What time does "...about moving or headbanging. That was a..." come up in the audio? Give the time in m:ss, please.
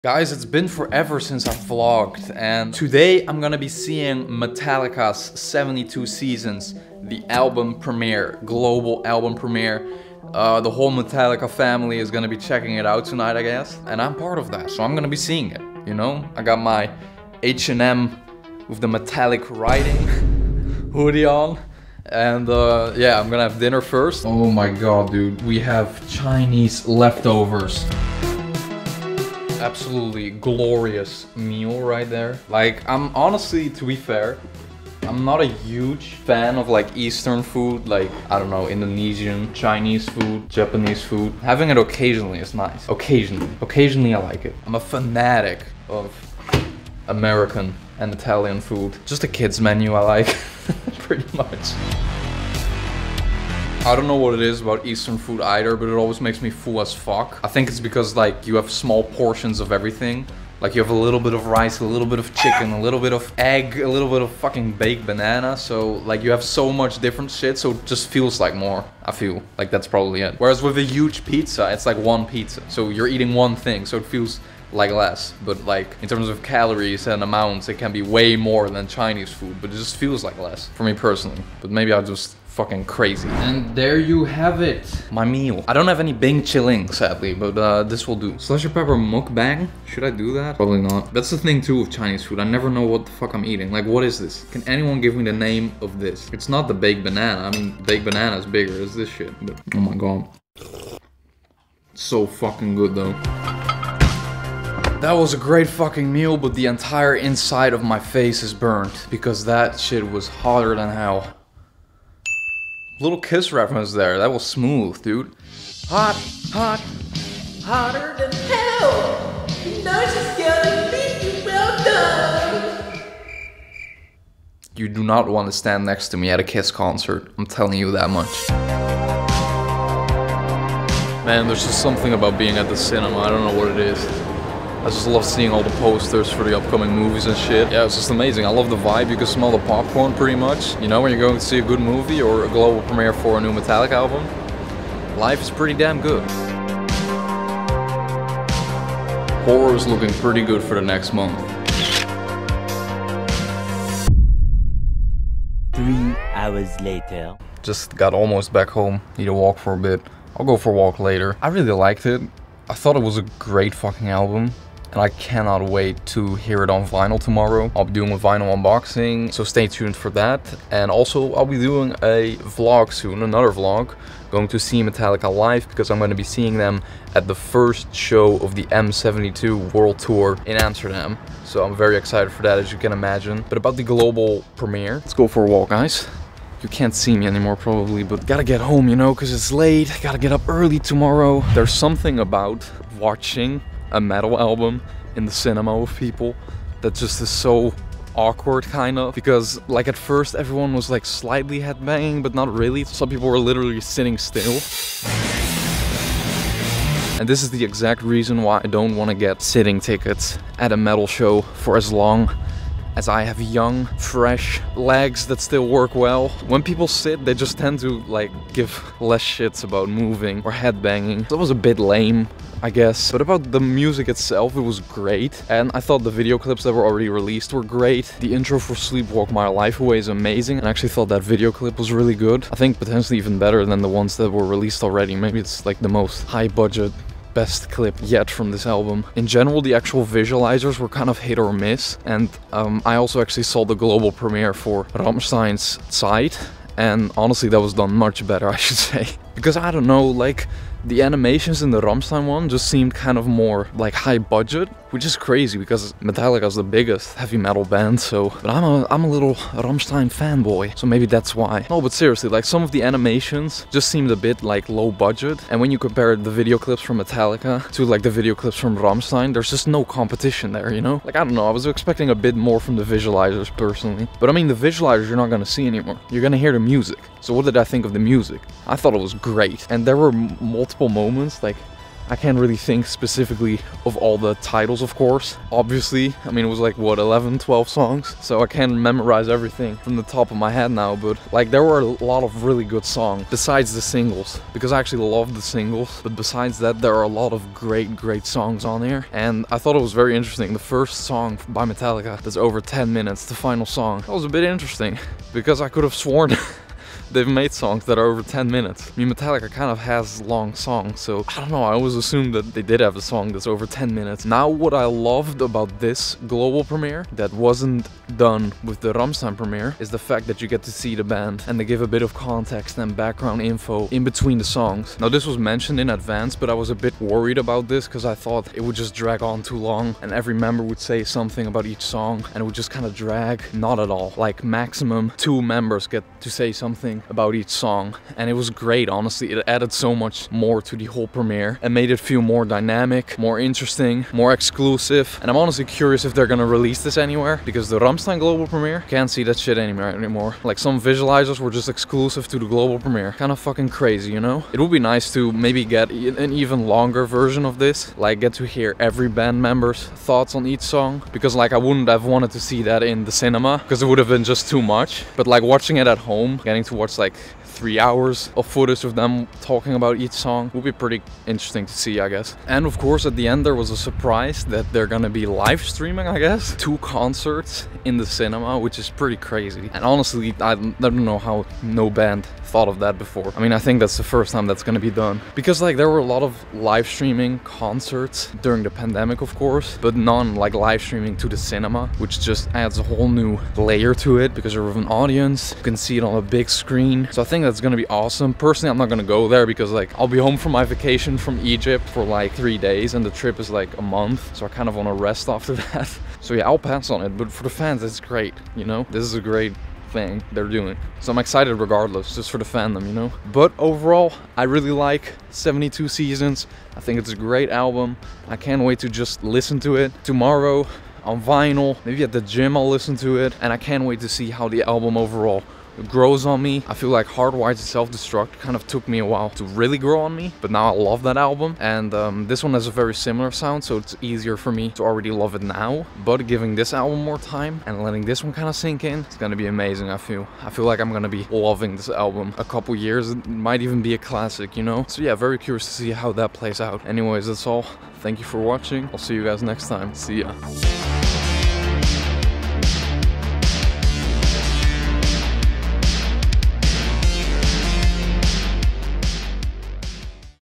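3:39.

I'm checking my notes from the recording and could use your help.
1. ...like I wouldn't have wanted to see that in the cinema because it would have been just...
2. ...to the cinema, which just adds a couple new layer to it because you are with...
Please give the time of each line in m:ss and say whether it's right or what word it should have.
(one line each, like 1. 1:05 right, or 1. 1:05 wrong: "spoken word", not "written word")
1. 6:01 right
2. 6:31 wrong: "whole", not "couple".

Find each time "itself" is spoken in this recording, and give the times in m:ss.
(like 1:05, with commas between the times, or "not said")
3:44.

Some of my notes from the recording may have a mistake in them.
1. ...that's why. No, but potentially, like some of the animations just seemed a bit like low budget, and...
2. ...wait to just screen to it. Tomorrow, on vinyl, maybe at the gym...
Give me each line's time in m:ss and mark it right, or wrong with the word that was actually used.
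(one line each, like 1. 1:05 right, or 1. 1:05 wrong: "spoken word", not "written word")
1. 4:21 wrong: "seriously", not "potentially"
2. 6:58 wrong: "listen", not "screen".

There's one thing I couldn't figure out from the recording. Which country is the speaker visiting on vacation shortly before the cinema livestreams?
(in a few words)
Egypt.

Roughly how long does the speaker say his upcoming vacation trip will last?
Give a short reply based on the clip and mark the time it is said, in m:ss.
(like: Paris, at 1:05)
A month, at 6:43.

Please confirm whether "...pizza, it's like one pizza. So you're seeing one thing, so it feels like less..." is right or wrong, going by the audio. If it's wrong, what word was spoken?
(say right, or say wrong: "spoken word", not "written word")
wrong: "eating", not "seeing".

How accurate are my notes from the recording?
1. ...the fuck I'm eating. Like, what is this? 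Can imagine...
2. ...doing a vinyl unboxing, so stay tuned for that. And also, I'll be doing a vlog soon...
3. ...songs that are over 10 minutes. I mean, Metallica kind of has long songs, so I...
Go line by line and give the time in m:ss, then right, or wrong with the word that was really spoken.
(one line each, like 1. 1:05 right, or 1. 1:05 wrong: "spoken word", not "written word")
1. 1:33 wrong: "anyone", not "imagine"
2. 2:47 right
3. 5:07 right.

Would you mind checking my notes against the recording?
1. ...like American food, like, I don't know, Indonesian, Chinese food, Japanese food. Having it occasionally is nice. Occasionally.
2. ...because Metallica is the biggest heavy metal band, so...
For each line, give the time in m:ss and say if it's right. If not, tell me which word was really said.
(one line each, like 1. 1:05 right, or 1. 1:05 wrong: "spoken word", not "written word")
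1. 0:36 wrong: "Eastern", not "American"
2. 4:15 right.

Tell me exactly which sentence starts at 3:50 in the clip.
And I actually thought that video clip was really good.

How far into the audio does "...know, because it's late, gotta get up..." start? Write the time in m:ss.
3:08.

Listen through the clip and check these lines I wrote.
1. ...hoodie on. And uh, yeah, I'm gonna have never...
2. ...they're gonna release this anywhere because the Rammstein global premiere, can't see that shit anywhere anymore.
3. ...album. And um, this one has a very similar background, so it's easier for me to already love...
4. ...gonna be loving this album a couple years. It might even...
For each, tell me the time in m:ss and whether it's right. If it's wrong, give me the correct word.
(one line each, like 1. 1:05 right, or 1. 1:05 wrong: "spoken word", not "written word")
1. 0:20 wrong: "dinner", not "never"
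2. 5:46 right
3. 7:11 wrong: "sound", not "background"
4. 7:20 right.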